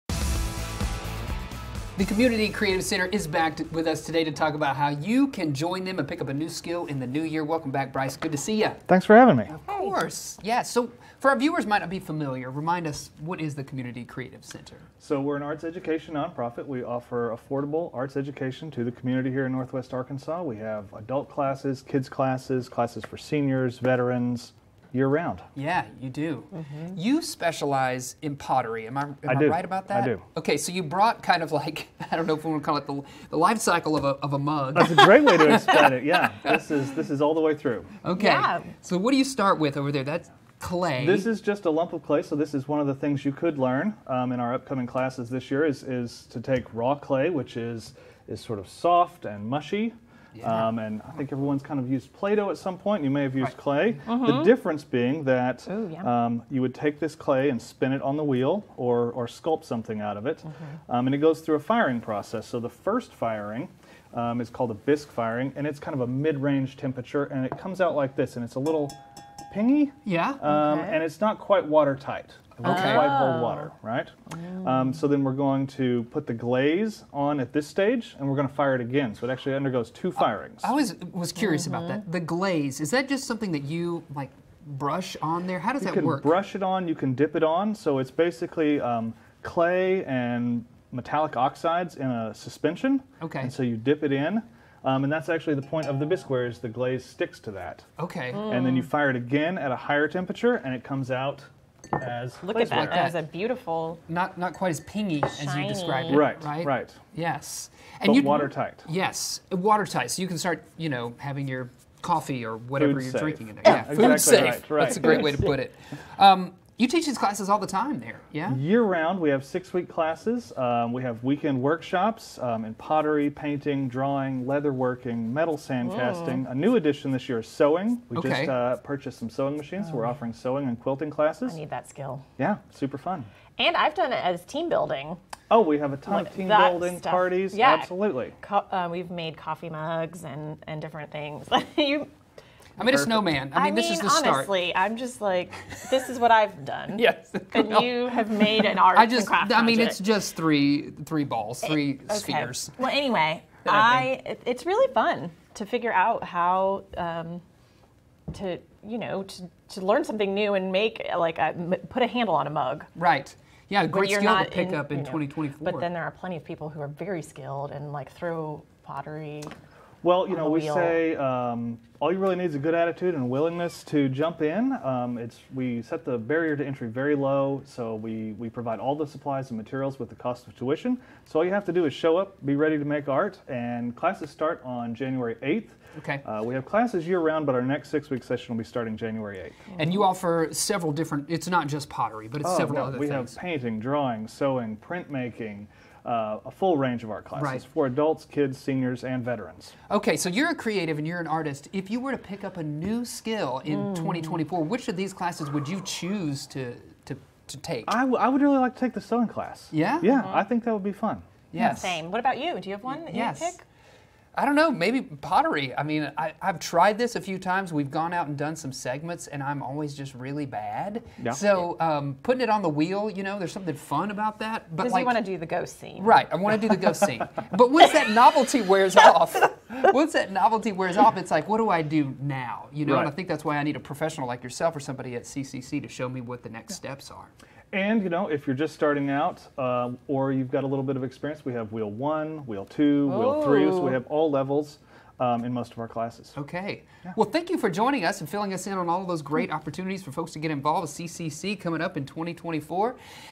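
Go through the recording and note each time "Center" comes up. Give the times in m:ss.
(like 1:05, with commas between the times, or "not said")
0:02, 0:14.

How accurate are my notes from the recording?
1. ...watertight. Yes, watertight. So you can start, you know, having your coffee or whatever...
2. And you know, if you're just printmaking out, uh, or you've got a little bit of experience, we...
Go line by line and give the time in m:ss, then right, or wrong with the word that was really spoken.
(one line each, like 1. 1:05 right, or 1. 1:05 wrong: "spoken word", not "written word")
1. 1:48 right
2. 3:57 wrong: "starting", not "printmaking".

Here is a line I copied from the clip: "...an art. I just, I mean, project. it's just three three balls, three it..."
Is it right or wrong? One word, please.
right.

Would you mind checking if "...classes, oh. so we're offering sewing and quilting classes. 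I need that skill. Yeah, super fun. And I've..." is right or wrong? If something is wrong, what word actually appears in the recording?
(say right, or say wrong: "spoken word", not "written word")
wrong: "machines", not "classes".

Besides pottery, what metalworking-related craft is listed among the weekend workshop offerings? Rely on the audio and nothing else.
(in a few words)
metal sand casting.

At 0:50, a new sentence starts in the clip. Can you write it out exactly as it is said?
Um, and I think everyone's kind of used Play-Doh at some point.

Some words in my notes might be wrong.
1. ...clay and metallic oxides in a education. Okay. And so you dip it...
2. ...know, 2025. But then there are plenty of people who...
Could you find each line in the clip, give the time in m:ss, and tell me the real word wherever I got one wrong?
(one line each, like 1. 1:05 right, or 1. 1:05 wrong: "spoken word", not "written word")
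1. 1:29 wrong: "suspension", not "education"
2. 2:45 wrong: "2024", not "2025".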